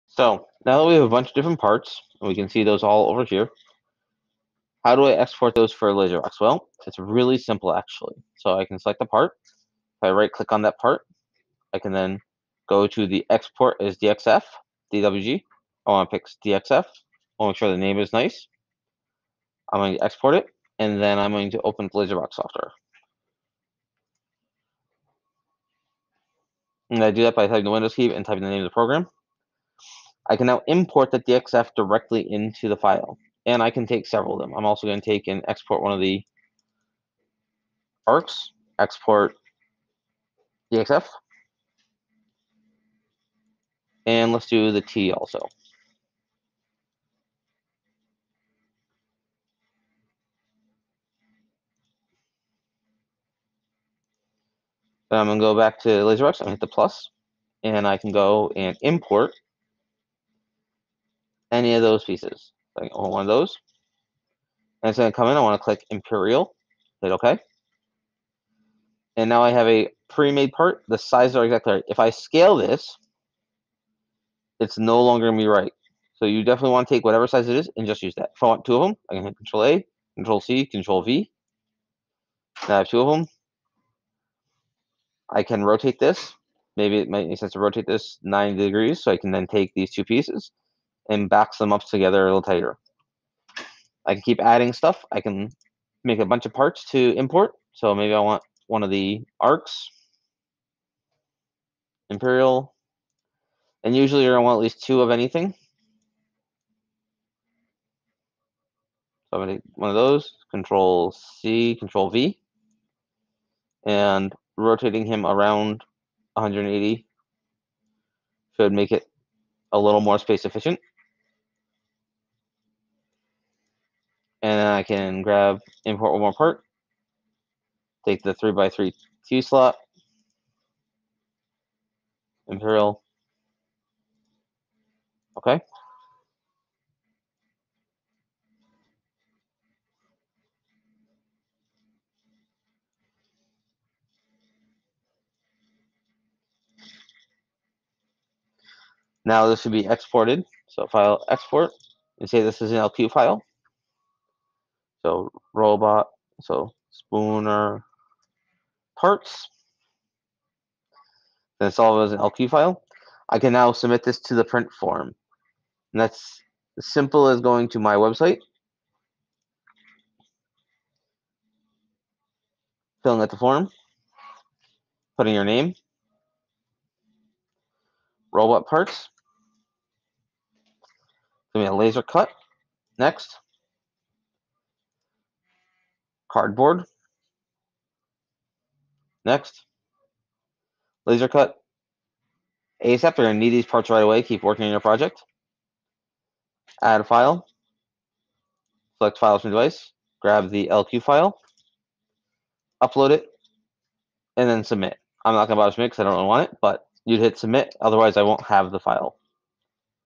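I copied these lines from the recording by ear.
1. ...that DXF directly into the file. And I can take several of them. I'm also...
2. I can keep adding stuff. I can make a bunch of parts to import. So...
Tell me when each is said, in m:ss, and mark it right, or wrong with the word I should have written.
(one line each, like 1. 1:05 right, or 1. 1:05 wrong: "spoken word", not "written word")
1. 0:31 right
2. 1:34 right.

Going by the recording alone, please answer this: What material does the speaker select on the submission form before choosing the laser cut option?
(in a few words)
cardboard.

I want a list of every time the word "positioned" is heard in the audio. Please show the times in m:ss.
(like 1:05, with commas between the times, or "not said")
not said.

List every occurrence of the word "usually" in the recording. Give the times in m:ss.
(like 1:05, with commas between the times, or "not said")
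1:43.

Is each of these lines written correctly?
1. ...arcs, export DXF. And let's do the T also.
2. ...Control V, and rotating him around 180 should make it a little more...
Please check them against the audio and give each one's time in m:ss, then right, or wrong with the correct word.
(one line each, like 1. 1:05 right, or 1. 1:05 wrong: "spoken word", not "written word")
1. 0:38 right
2. 1:51 right.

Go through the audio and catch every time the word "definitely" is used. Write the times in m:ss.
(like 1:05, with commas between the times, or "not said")
1:16.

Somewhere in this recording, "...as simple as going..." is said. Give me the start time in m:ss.
2:46.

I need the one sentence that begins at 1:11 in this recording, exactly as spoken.
If I scale this, it's no longer going to be right.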